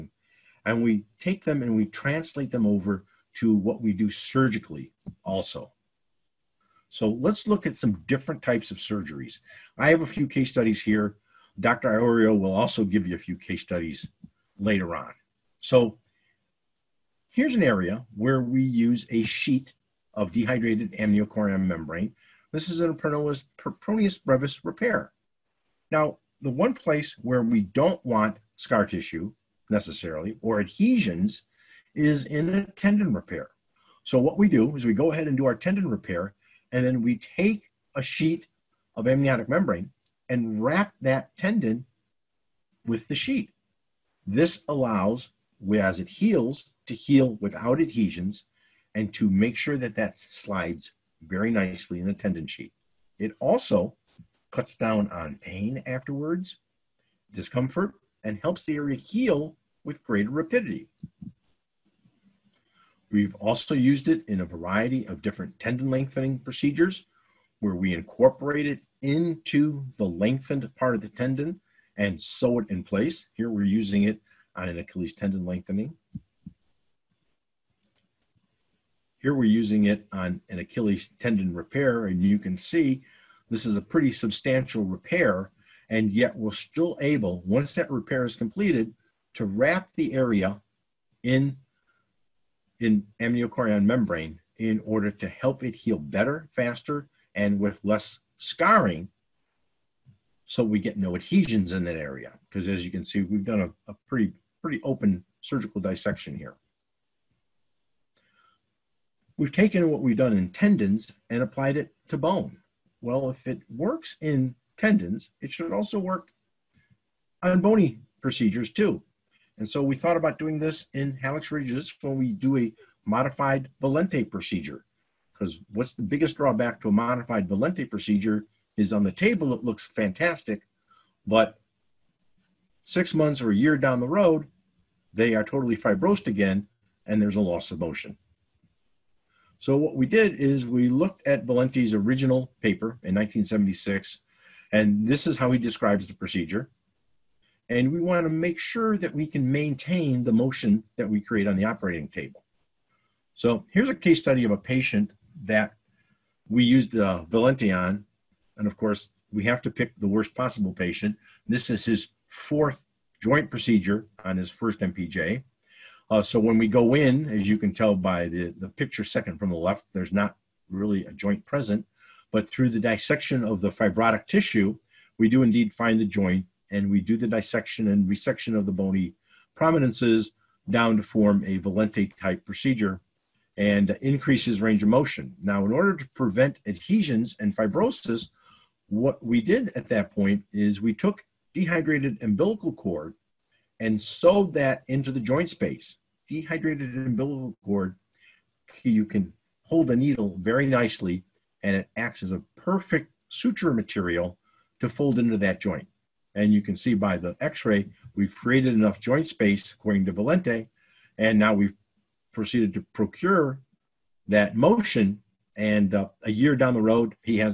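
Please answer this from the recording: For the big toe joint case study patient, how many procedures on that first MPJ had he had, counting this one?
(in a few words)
His fourth.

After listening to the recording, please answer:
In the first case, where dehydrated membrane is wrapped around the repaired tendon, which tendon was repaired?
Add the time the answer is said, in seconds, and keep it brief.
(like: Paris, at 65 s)
Peroneus brevis, at 22 s.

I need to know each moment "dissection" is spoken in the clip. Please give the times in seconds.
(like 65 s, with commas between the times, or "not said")
105 s, 172 s, 177 s.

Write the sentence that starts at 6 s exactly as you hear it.
So let's look at some different types of surgeries.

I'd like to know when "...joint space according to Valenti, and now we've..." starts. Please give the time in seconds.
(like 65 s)
208 s.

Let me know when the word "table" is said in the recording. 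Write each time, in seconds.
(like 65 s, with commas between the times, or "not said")
129 s, 152 s.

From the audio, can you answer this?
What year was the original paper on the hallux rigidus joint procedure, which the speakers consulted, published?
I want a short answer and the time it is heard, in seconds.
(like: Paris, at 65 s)
1976, at 143 s.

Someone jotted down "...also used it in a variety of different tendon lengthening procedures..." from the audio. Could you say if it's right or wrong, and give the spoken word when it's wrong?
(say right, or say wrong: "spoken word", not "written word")
right.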